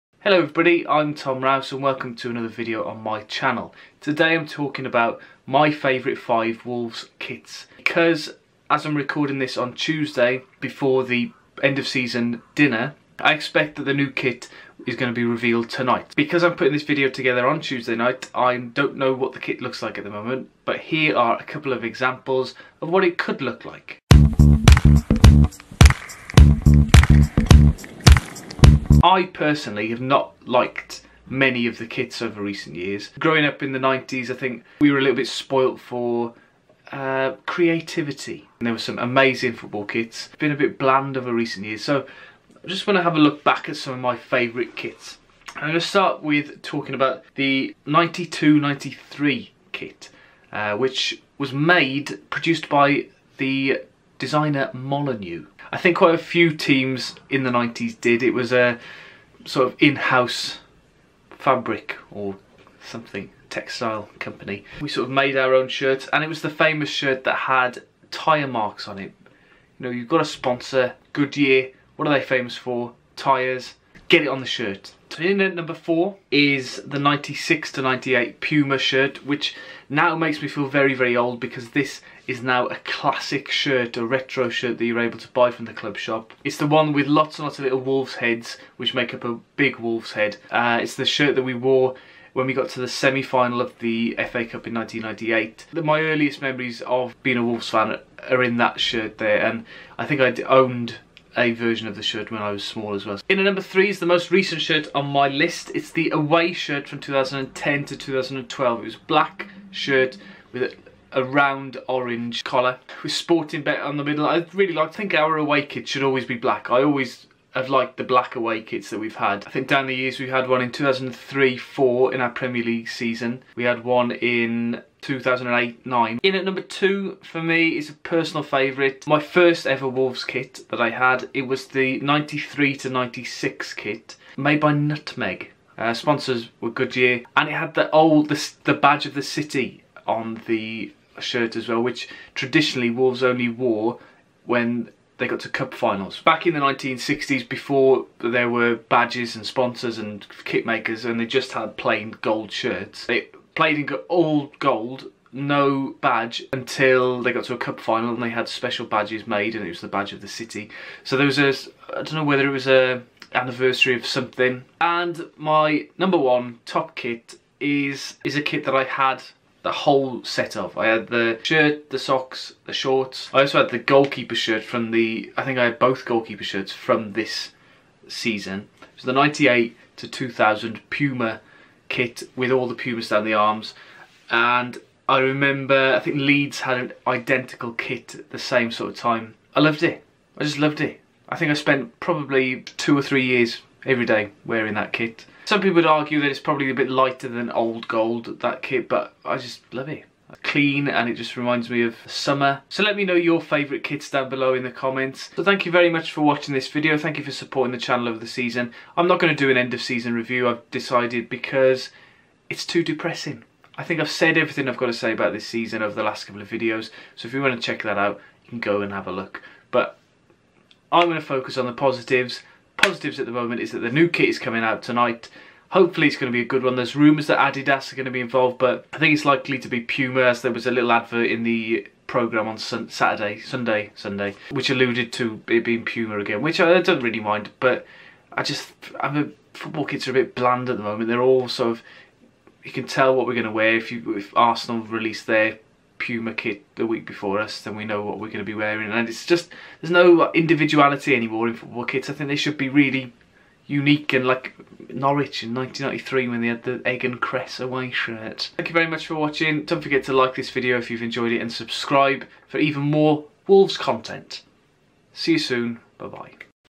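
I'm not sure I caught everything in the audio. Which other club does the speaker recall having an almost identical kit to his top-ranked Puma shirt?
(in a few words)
Leeds.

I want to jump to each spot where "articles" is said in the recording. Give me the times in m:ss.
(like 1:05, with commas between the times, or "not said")
not said.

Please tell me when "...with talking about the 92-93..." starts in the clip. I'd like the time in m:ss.
0:46.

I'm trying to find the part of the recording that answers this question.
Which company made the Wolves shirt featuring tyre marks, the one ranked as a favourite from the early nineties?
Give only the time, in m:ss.
0:54.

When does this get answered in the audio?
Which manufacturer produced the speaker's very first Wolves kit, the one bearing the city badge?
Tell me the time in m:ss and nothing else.
2:14.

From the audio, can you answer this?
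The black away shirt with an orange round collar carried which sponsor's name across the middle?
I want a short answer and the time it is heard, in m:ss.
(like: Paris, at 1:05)
Sportingbet, at 1:53.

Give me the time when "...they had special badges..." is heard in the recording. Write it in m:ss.
2:38.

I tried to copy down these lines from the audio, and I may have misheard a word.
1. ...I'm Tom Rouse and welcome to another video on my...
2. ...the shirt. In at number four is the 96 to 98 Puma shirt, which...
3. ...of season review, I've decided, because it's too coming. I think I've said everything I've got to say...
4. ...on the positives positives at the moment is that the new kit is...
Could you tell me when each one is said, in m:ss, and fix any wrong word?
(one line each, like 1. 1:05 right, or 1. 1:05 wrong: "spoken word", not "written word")
1. 0:00 right
2. 1:14 right
3. 3:29 wrong: "depressing", not "coming"
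4. 3:41 right.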